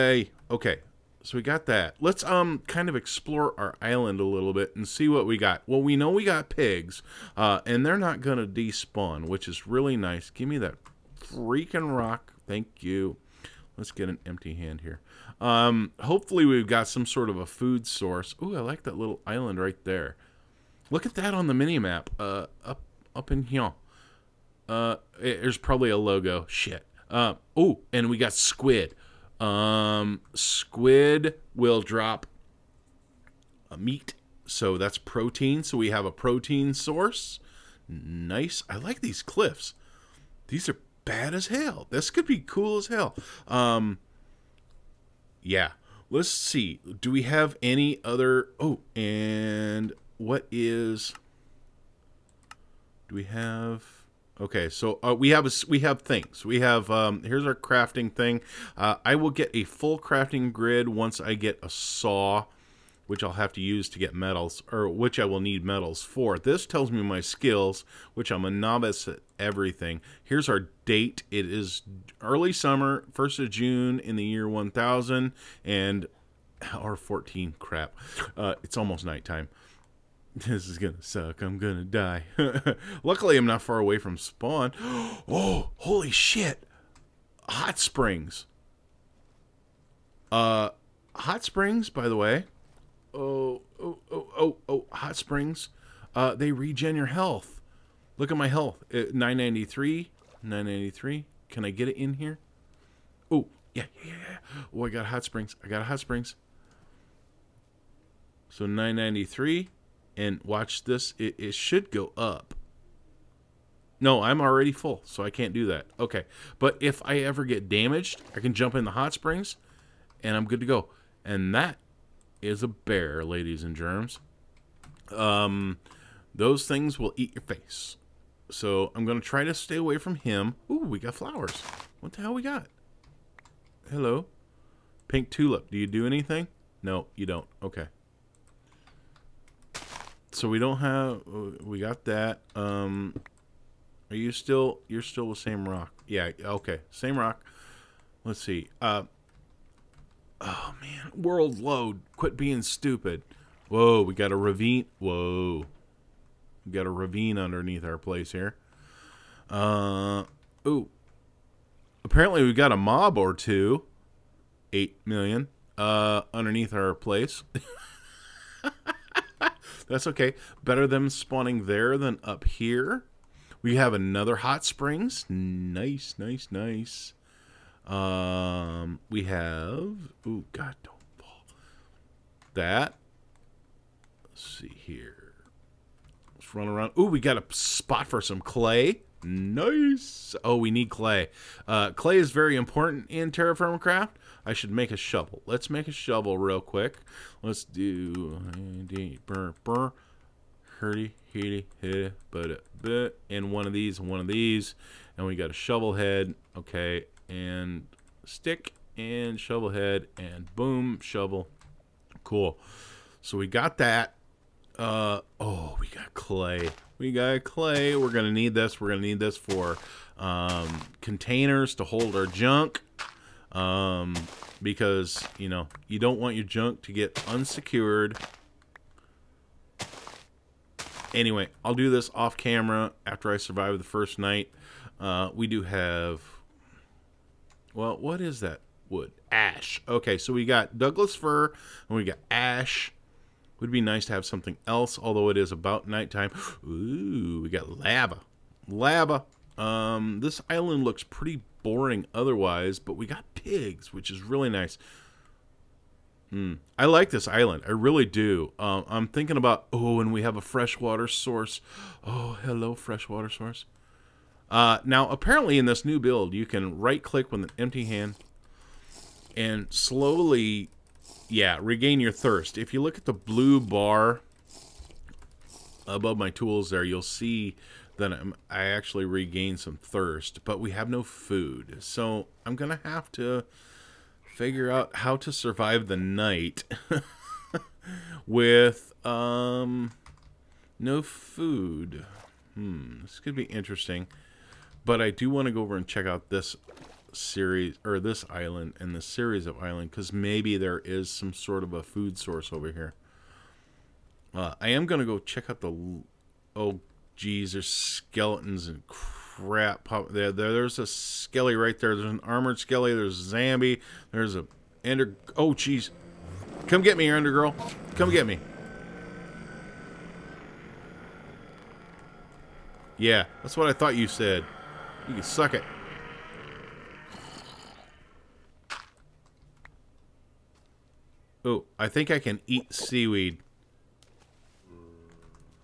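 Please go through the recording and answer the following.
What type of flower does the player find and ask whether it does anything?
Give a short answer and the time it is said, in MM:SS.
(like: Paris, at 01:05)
Pink tulip, at 02:15.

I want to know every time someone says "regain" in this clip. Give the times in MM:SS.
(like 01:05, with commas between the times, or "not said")
04:31, 04:39.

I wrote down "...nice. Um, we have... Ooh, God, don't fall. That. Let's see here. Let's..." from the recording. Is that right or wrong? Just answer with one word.
right.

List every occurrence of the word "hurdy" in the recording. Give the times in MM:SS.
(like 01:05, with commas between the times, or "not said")
03:20.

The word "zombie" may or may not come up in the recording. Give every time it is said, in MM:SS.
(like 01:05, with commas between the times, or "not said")
05:13.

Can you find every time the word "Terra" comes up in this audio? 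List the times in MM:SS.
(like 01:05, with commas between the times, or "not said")
03:13.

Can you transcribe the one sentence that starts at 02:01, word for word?
And that is a bear, ladies and germs.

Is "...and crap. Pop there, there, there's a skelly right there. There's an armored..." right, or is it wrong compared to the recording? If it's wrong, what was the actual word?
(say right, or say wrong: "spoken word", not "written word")
right.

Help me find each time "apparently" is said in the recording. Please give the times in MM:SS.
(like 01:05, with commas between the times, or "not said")
02:42, 04:25.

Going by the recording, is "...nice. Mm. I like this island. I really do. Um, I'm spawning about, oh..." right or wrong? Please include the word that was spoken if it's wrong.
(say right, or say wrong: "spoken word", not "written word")
wrong: "thinking", not "spawning".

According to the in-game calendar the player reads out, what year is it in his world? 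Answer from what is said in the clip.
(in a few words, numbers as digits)
1000.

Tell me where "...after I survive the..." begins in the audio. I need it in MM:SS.
03:53.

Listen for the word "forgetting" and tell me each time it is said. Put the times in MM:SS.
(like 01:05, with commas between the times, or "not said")
not said.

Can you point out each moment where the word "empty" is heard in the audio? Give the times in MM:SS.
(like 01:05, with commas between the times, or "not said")
00:14, 04:27.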